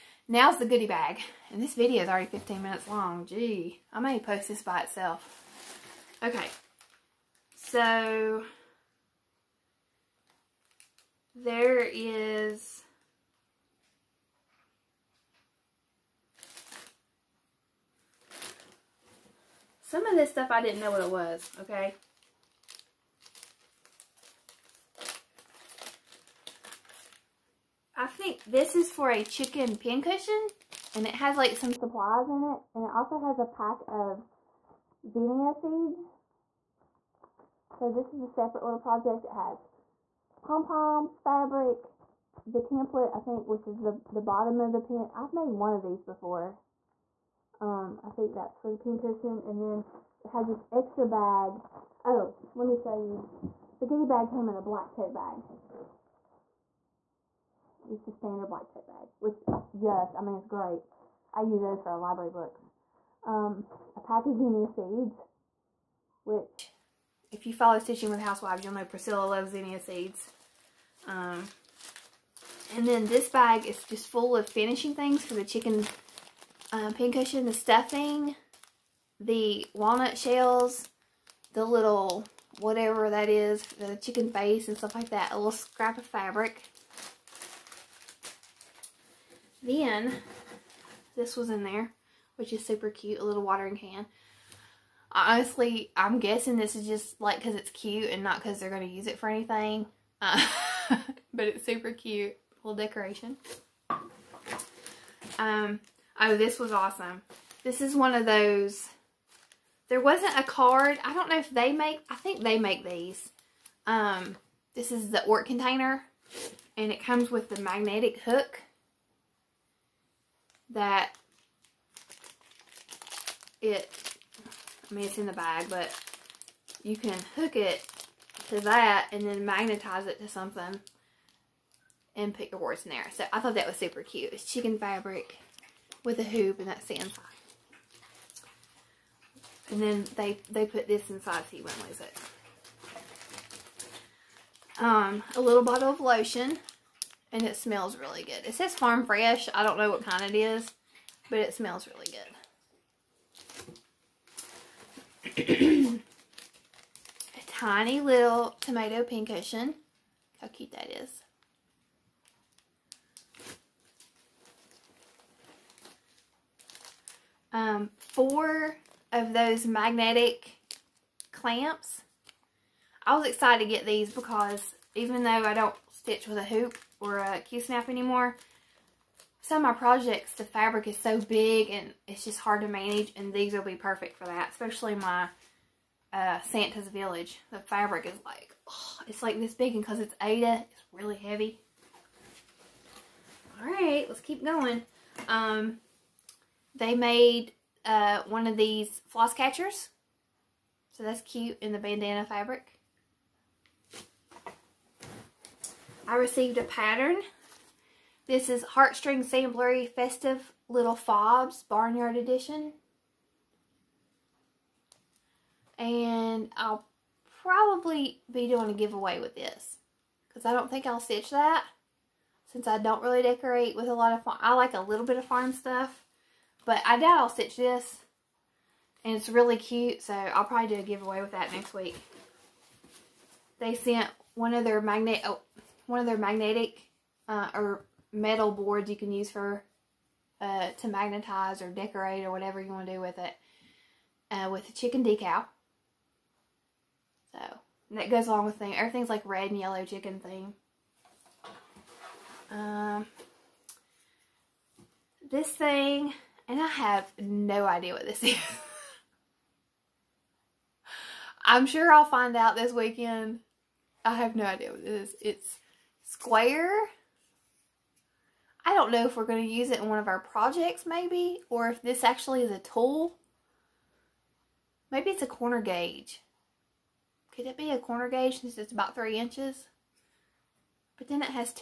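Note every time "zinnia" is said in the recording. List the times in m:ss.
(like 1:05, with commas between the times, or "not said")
0:35, 1:04, 1:09.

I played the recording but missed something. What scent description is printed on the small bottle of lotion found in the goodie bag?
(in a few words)
Farm fresh.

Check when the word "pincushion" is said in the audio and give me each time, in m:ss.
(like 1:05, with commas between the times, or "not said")
0:29, 0:48, 1:16, 2:39.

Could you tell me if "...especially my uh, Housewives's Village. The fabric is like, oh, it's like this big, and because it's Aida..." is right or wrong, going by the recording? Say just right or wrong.
wrong.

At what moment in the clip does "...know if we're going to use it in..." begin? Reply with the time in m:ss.
4:28.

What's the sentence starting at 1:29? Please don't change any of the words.
Then this was in there, which is super cute, a little watering can.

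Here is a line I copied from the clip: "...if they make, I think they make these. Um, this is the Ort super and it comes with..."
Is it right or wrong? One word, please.
wrong.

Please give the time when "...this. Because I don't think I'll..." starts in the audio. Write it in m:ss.
3:39.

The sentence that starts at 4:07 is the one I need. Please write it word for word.
So that goes along with thing.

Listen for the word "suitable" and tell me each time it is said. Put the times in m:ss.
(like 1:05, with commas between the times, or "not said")
not said.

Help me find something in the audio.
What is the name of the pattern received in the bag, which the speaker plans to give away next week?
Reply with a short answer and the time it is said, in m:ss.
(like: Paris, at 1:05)
Festive Little Fobs Barnyard Edition, at 3:29.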